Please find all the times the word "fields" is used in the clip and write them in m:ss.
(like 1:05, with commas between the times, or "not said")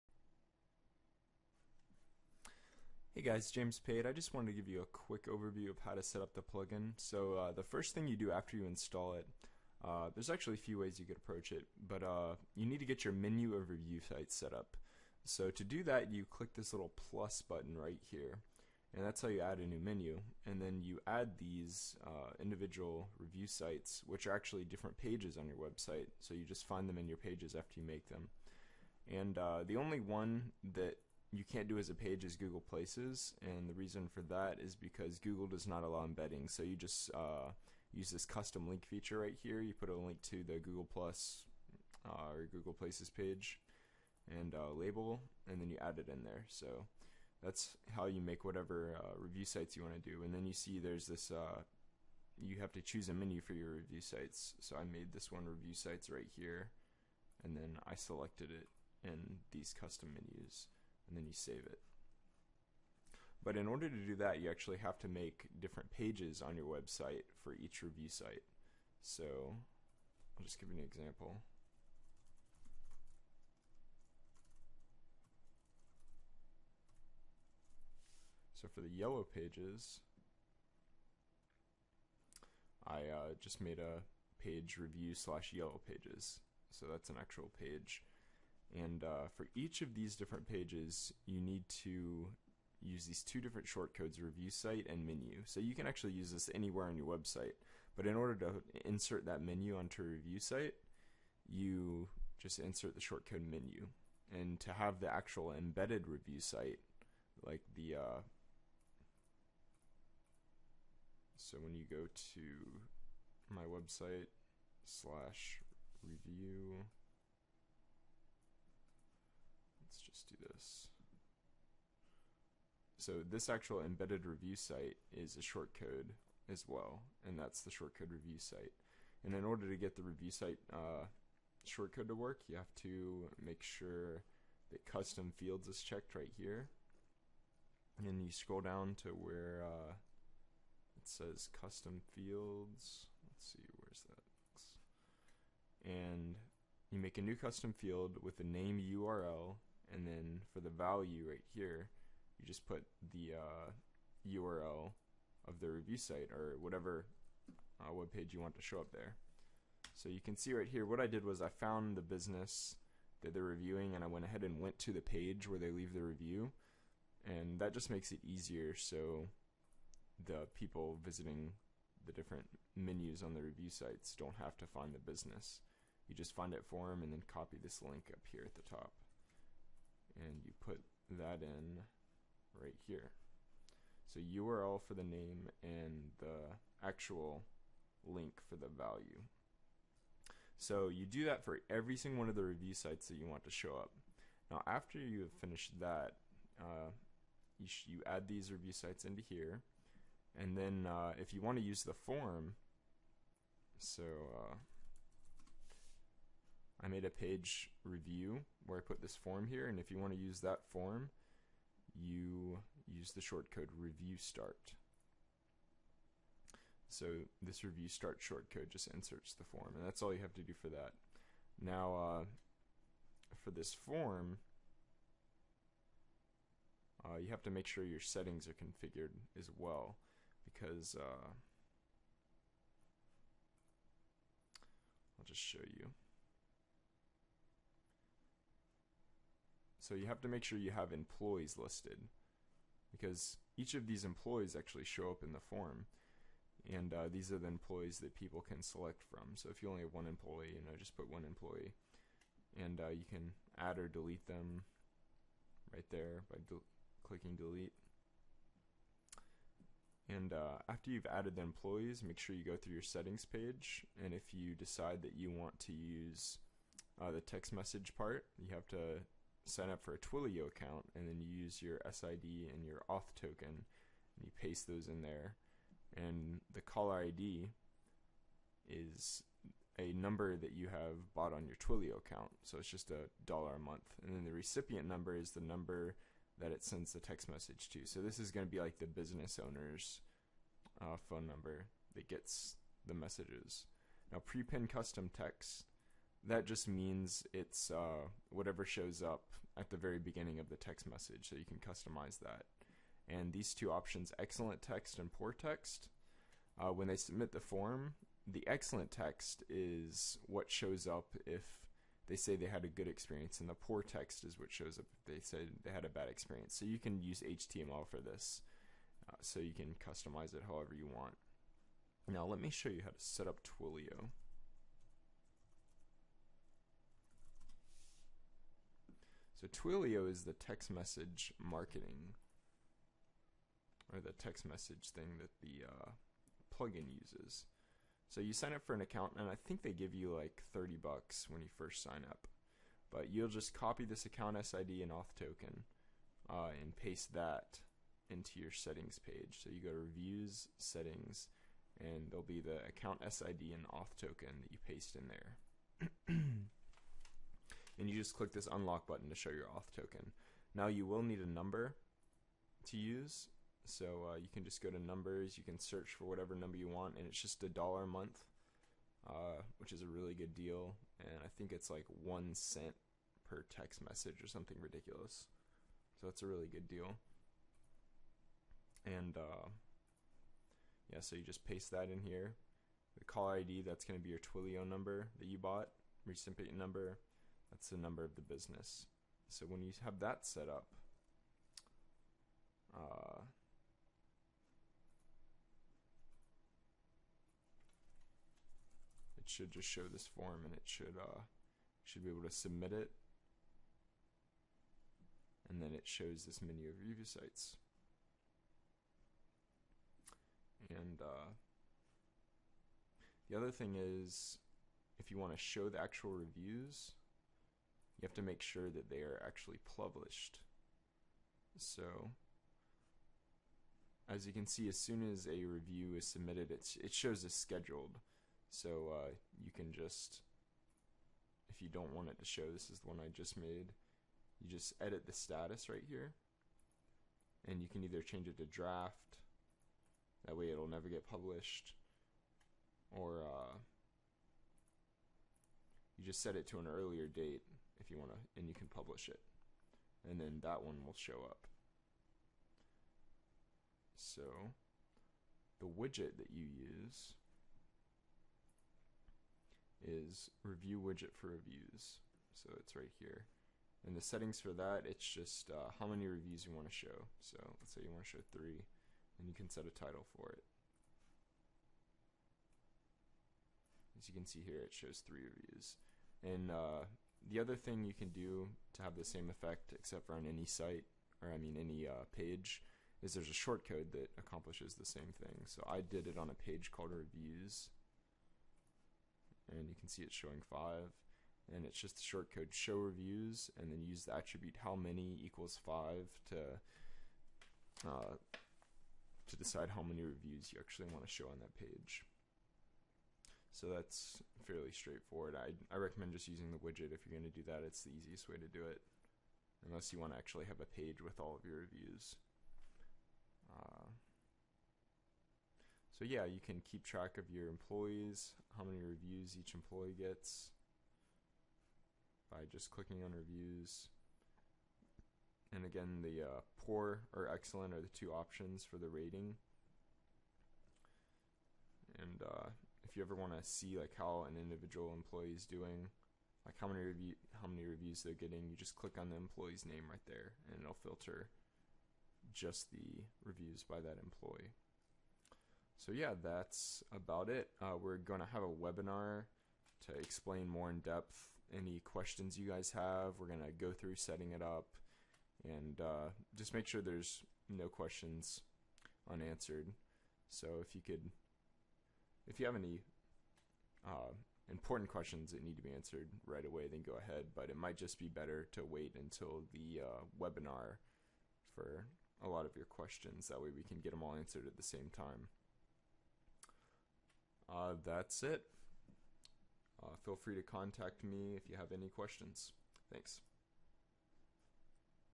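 2:15, 2:22, 2:27.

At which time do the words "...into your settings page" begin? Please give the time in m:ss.
5:48.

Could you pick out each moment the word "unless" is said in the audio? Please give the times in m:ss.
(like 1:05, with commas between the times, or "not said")
8:29.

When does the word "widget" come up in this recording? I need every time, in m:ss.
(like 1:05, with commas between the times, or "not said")
7:35, 7:40, 8:26.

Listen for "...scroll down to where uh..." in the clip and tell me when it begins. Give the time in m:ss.
2:18.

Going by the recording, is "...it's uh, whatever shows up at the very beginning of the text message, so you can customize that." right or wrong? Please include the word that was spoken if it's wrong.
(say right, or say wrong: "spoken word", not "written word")
right.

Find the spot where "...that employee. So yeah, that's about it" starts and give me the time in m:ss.
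9:03.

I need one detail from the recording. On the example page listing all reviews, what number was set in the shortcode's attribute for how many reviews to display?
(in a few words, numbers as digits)
5.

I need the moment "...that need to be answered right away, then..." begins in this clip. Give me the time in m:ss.
9:25.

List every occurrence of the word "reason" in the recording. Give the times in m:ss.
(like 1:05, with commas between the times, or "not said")
0:33.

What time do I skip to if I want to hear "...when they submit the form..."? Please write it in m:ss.
5:06.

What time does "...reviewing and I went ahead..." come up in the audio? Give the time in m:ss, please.
2:43.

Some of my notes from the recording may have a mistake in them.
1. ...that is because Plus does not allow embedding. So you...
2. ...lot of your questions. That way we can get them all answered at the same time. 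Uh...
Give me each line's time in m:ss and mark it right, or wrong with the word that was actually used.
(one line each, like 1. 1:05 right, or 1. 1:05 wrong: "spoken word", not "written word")
1. 0:34 wrong: "Google", not "Plus"
2. 9:32 right.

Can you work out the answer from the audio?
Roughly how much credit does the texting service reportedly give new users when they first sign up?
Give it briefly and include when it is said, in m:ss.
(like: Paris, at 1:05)
30 bucks, at 5:40.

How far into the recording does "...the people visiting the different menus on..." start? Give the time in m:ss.
2:50.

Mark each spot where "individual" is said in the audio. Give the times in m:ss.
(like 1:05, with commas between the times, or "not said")
0:22, 8:54.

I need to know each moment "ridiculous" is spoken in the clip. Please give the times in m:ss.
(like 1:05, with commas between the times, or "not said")
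6:14.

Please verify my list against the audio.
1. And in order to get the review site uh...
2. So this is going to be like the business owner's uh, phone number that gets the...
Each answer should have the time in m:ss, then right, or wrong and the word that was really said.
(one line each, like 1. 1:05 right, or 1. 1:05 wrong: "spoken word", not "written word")
1. 2:09 right
2. 4:47 right.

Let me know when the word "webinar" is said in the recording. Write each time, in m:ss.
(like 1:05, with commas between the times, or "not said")
9:08, 9:30.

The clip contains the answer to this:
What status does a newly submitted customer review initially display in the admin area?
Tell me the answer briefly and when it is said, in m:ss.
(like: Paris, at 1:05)
scheduled, at 7:07.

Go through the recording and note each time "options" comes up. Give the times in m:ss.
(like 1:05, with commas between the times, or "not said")
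5:03, 8:48.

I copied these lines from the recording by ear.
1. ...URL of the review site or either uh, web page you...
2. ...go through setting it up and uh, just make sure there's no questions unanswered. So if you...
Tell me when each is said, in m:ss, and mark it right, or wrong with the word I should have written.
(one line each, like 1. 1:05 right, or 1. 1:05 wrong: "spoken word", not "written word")
1. 2:34 wrong: "whatever", not "either"
2. 9:13 right.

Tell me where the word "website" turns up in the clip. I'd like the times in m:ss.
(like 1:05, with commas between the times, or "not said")
0:25, 1:06, 1:37, 1:53.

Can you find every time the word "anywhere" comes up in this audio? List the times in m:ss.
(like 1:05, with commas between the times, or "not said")
1:36.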